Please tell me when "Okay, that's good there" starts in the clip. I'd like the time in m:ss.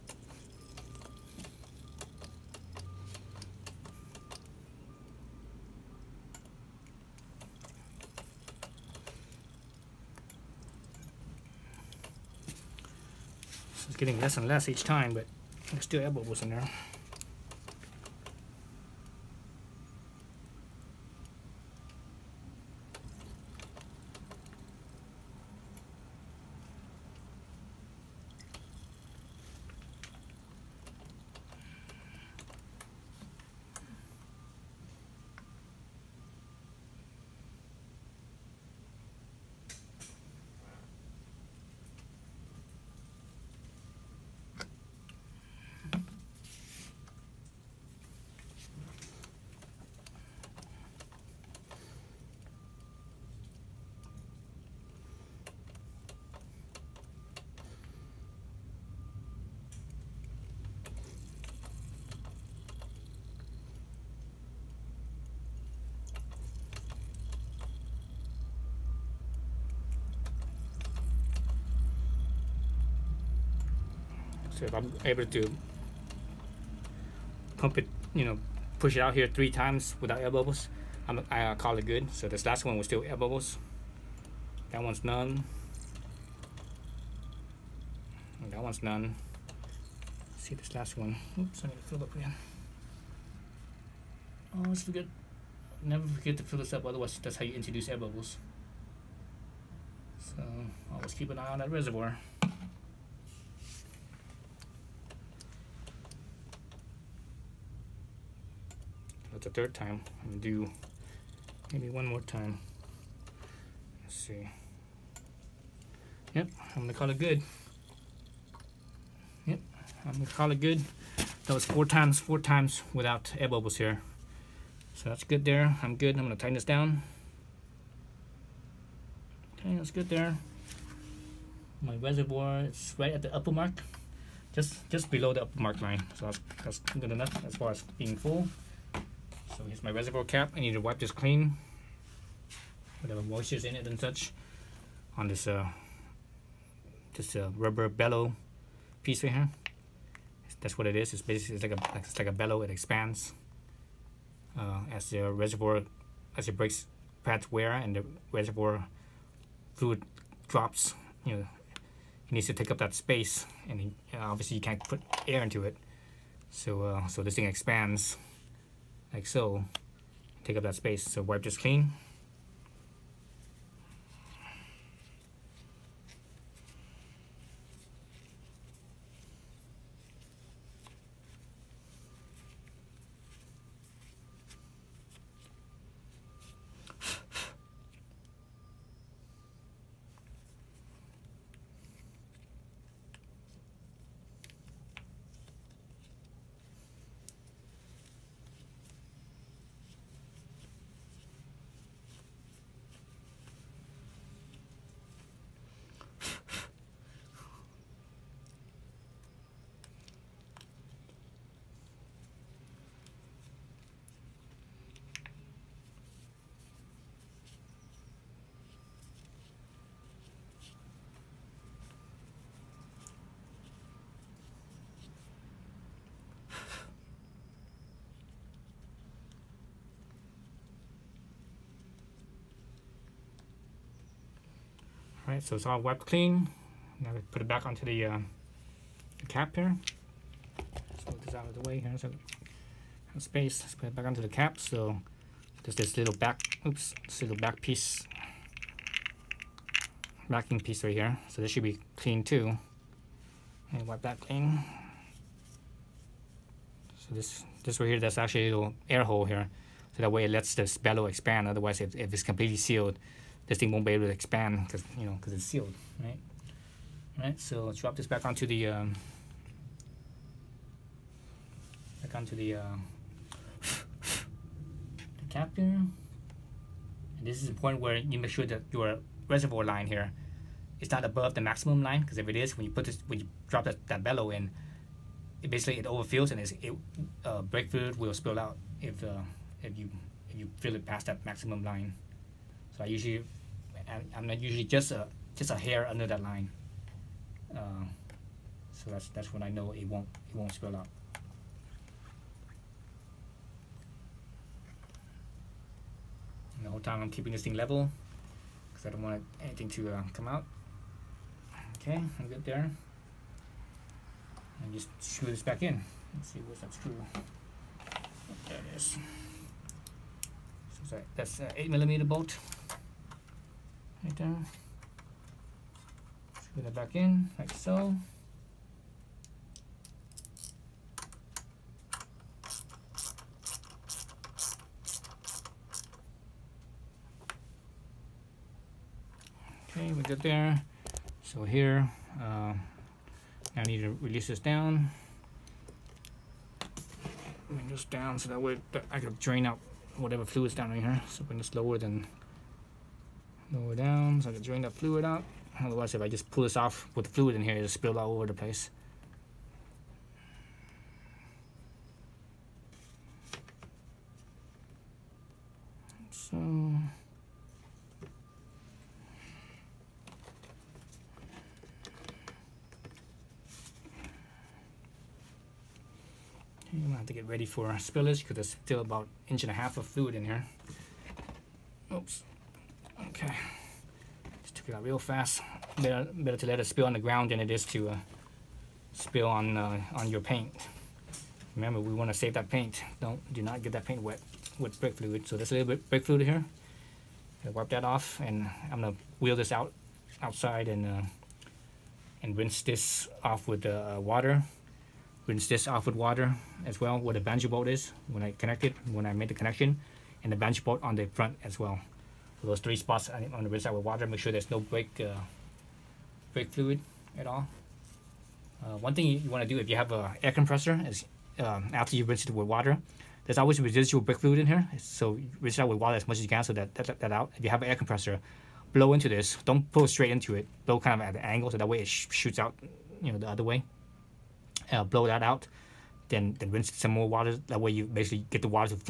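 2:09.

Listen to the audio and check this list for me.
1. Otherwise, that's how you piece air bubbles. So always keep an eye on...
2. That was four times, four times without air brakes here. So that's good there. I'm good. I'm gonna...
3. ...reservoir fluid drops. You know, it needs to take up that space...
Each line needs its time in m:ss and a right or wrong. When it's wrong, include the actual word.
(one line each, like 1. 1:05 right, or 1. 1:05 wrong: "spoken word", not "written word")
1. 1:36 wrong: "introduce", not "piece"
2. 2:01 wrong: "bubbles", not "brakes"
3. 2:38 right.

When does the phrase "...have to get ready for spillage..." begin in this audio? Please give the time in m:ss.
6:16.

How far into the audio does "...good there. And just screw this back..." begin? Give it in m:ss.
5:12.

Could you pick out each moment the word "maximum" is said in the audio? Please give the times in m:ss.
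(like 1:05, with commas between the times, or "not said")
4:41, 4:51.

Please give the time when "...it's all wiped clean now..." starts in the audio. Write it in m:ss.
3:55.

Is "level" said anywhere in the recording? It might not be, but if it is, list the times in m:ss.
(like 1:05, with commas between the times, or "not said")
5:07.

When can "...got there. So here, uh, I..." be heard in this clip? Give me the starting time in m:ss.
5:40.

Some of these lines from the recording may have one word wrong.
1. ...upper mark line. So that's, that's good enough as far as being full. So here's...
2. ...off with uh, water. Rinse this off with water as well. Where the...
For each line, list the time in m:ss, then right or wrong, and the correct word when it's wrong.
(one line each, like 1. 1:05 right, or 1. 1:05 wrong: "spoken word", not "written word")
1. 2:15 right
2. 6:43 right.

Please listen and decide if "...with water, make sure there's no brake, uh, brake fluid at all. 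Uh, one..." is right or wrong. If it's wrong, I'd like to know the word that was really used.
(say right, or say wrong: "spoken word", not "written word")
right.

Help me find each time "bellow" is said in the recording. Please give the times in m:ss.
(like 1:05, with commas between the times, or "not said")
2:27, 2:32, 4:20, 4:44.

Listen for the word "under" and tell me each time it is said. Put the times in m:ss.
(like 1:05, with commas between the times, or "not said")
4:55.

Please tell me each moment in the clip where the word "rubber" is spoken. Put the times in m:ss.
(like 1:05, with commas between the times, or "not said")
2:27.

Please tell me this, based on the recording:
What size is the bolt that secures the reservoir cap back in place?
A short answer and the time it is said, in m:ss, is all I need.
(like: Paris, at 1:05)
8 millimeter, at 5:21.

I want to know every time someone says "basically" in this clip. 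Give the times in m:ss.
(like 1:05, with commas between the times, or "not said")
2:31, 4:45, 7:17.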